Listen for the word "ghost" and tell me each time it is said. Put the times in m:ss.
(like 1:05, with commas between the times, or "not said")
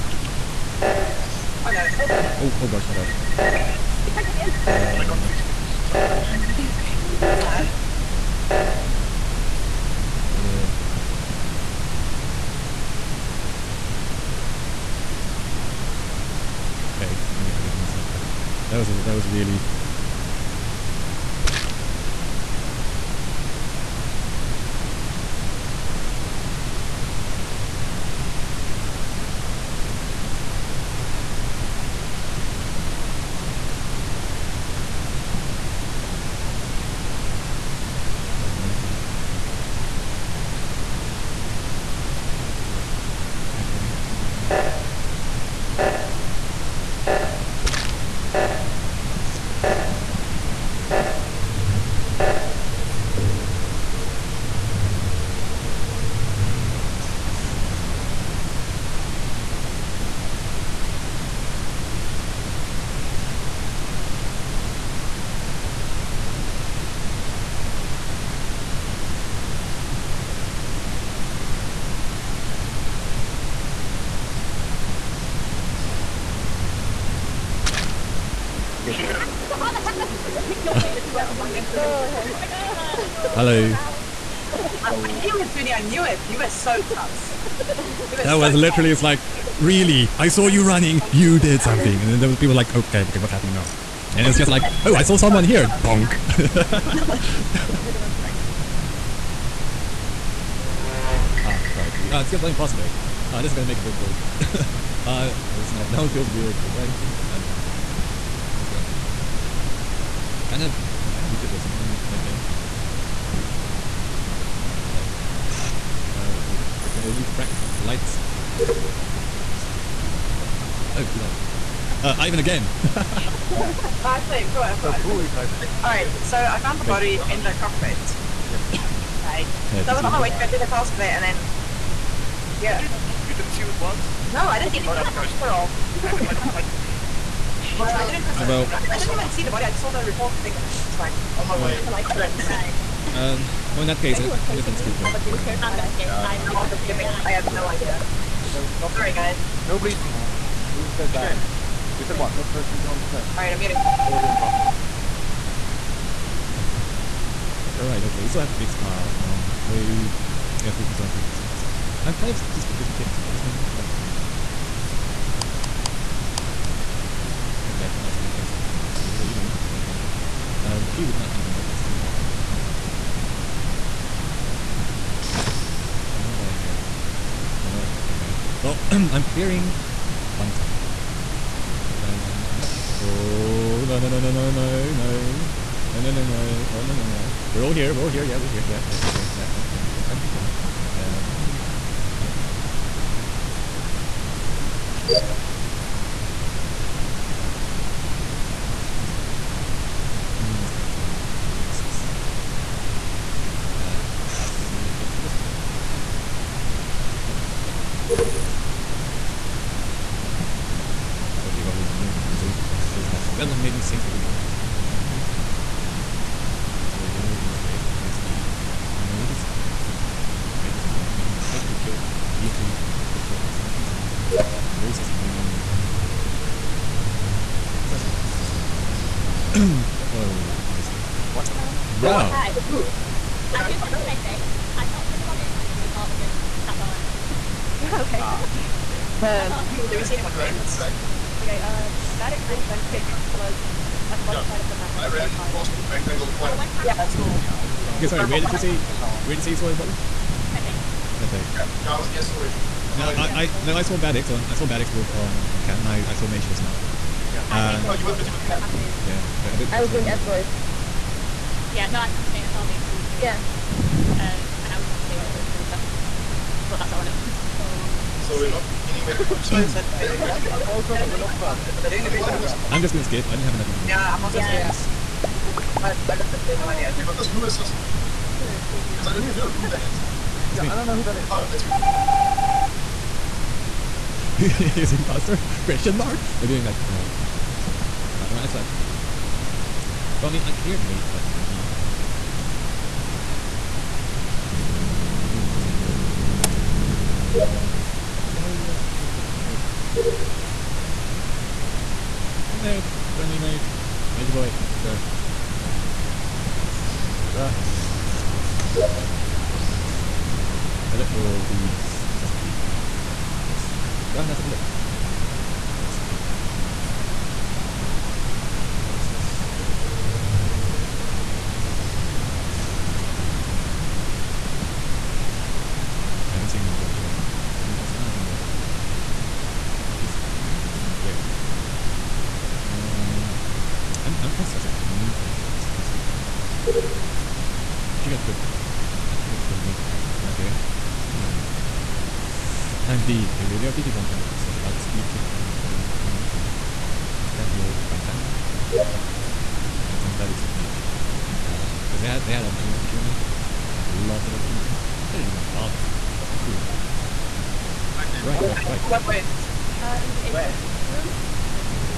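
2:15.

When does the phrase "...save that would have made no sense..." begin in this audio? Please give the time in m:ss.
3:32.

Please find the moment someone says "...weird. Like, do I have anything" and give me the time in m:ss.
1:46.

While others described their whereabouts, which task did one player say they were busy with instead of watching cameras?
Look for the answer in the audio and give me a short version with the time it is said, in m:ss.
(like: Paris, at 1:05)
Asteroids, at 4:20.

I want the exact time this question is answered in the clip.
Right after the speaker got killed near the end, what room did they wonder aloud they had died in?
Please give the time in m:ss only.
6:00.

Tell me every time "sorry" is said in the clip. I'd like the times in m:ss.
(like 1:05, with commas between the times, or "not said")
2:14, 2:28, 4:08.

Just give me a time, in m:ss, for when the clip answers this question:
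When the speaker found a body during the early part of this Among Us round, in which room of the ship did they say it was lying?
2:07.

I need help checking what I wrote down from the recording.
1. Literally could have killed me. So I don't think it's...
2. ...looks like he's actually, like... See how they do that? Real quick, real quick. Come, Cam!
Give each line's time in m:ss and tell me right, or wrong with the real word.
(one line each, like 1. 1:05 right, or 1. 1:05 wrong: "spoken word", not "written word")
1. 3:42 right
2. 4:55 wrong: "Mage", not "Cam".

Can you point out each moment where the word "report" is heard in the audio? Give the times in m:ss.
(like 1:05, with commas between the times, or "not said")
2:20, 3:55.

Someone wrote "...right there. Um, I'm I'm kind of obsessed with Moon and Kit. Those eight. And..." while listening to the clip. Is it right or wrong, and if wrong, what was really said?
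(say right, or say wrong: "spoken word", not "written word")
wrong: "two", not "eight".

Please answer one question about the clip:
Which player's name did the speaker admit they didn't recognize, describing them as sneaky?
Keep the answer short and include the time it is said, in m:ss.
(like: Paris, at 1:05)
Pillar, at 4:38.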